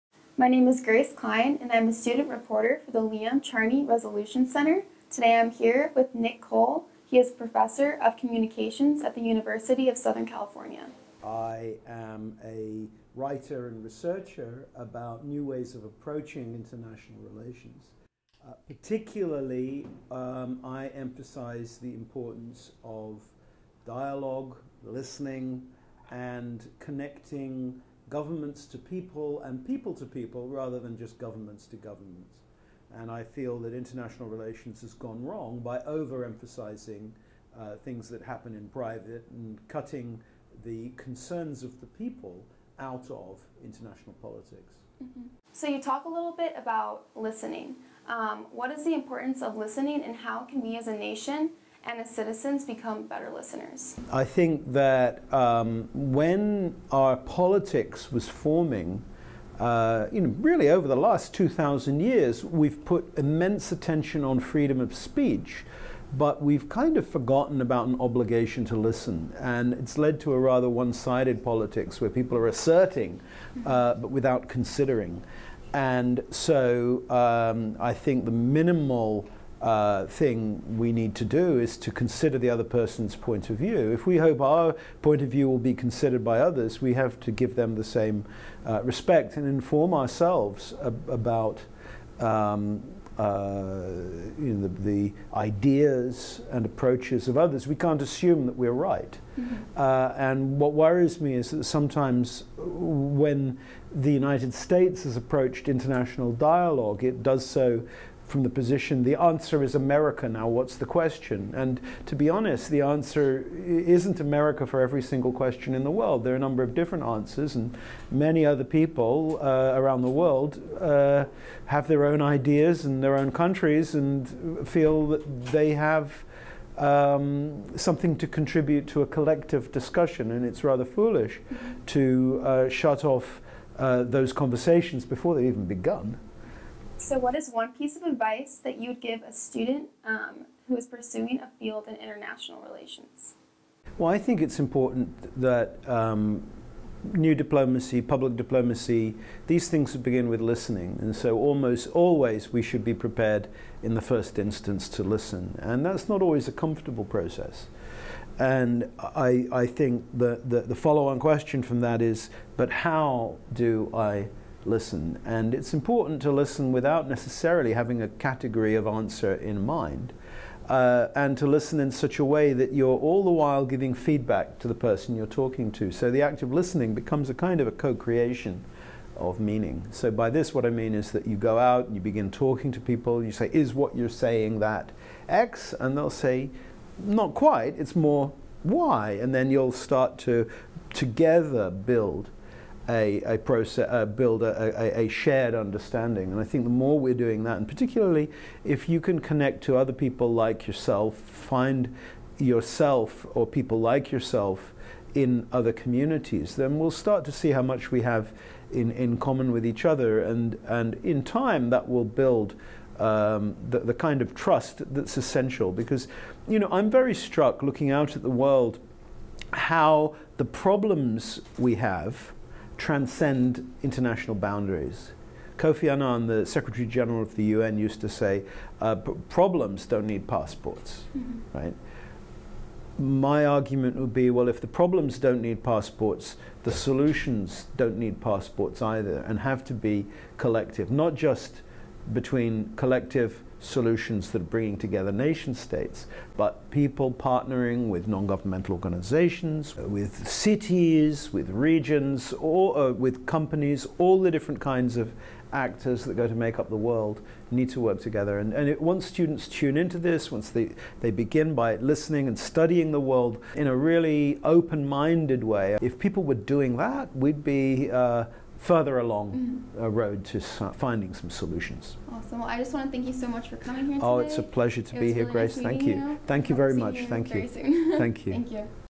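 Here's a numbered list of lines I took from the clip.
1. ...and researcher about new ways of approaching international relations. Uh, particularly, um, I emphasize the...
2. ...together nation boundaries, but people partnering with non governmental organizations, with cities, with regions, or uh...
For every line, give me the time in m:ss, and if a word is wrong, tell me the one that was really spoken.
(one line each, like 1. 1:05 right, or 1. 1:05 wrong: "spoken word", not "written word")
1. 0:13 right
2. 4:04 wrong: "states", not "boundaries".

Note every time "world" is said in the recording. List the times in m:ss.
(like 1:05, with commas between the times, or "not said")
1:55, 2:00, 3:38, 4:16, 4:23.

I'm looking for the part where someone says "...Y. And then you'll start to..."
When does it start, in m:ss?
3:08.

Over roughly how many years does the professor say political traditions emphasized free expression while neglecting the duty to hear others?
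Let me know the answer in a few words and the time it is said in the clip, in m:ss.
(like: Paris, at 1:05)
2,000, at 1:01.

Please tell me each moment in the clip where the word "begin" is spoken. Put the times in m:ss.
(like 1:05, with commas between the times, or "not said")
2:29, 3:02, 4:21.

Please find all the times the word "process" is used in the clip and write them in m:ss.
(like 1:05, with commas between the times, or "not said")
2:37, 3:13.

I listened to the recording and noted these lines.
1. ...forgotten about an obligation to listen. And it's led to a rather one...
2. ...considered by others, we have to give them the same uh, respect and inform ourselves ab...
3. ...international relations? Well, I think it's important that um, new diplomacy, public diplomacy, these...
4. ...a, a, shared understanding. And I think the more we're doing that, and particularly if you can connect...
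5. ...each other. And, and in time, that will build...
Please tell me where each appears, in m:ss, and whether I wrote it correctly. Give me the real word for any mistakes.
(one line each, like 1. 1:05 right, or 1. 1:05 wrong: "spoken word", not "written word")
1. 1:07 right
2. 1:25 right
3. 2:21 right
4. 3:15 right
5. 3:29 right.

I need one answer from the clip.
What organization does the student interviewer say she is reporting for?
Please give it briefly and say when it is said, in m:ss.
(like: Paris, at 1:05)
Leon Charney Resolution Center, at 0:03.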